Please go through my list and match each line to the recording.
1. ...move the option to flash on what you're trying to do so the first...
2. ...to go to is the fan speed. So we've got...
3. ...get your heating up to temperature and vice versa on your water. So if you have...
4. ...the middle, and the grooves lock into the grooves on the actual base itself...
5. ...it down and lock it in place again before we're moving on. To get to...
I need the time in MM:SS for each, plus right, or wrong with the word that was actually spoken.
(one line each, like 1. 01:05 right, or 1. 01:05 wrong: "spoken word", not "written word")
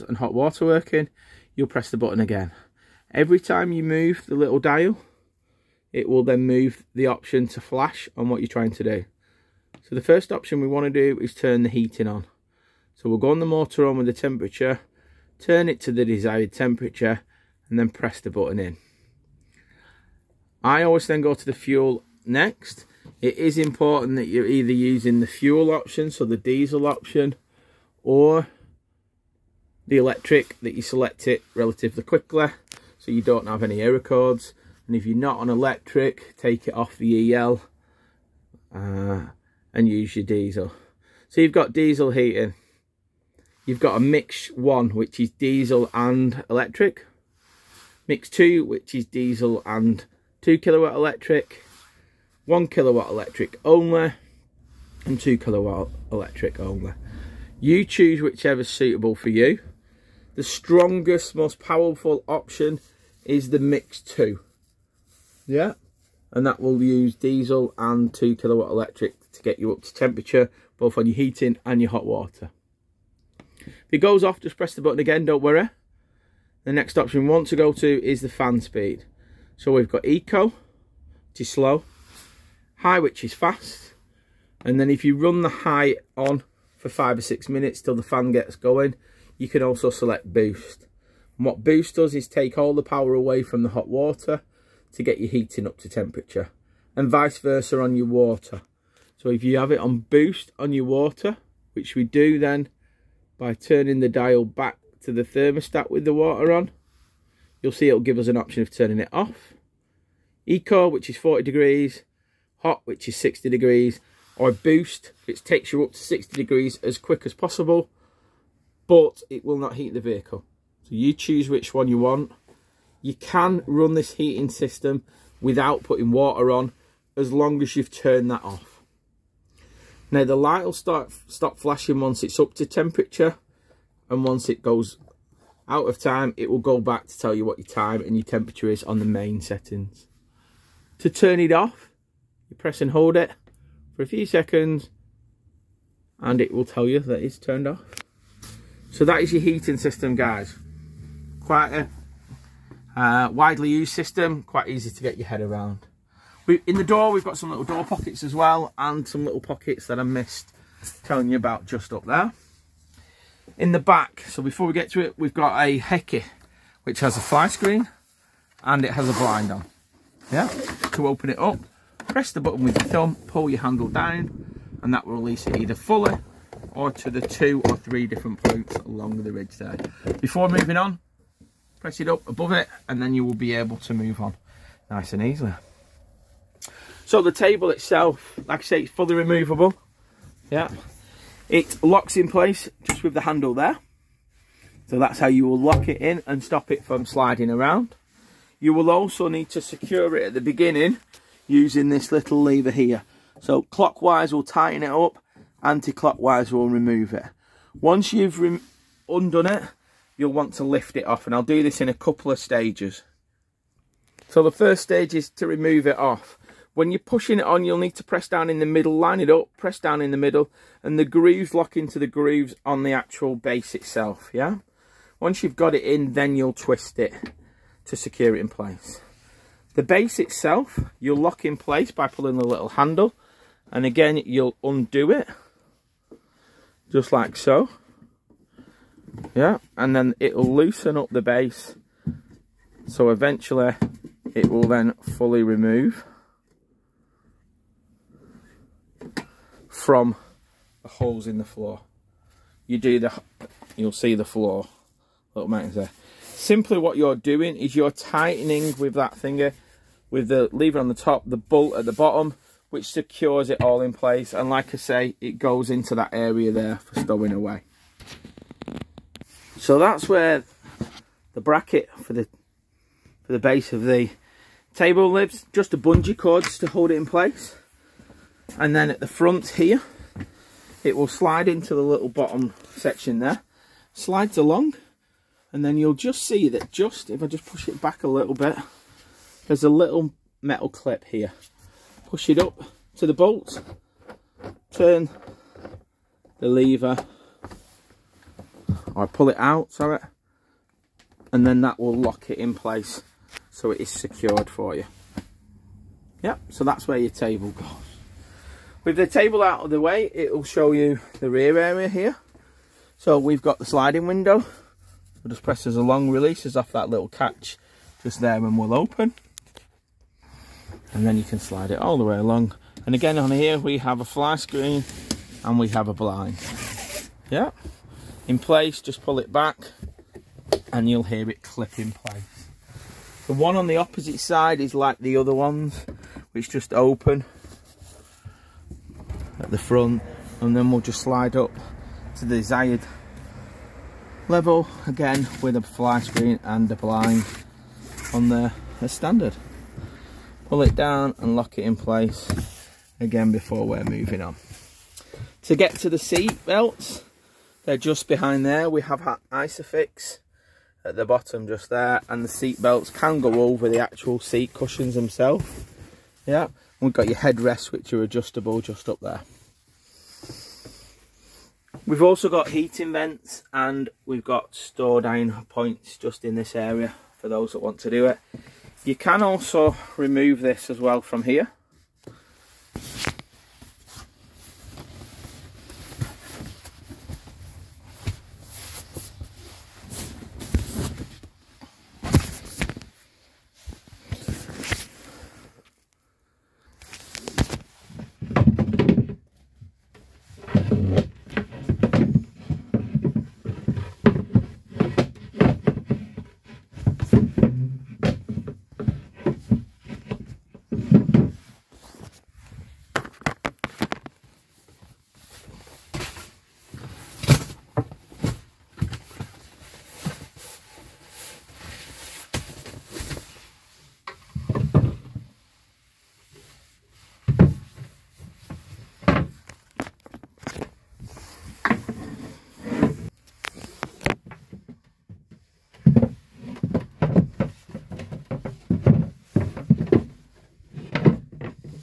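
1. 00:06 right
2. 01:17 right
3. 01:35 right
4. 03:40 right
5. 05:50 right.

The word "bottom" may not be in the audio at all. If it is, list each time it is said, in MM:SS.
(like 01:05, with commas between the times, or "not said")
04:21, 04:42, 06:01.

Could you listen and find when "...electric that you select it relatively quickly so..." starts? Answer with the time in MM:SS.
00:29.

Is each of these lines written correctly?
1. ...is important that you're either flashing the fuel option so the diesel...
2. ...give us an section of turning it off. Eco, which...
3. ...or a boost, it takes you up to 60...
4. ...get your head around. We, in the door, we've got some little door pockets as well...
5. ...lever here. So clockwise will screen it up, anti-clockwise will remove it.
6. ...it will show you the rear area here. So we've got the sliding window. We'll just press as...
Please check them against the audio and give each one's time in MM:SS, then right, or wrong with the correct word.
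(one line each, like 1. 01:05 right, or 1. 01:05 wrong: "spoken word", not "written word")
1. 00:23 wrong: "using", not "flashing"
2. 01:48 wrong: "option", not "section"
3. 01:54 right
4. 02:35 right
5. 03:22 wrong: "tighten", not "screen"
6. 05:10 right.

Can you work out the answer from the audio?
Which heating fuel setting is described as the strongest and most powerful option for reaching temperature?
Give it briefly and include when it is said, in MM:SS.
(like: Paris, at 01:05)
Mix 2, at 01:03.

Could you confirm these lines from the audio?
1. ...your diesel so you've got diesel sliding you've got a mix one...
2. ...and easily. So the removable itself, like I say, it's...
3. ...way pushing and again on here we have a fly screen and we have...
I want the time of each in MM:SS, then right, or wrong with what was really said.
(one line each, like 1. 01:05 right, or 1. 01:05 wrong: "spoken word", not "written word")
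1. 00:40 wrong: "heating", not "sliding"
2. 03:05 wrong: "table", not "removable"
3. 05:22 wrong: "along", not "pushing".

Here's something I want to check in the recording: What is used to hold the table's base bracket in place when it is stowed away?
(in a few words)
Bungee cords.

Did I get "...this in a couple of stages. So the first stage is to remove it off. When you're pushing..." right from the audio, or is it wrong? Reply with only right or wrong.
right.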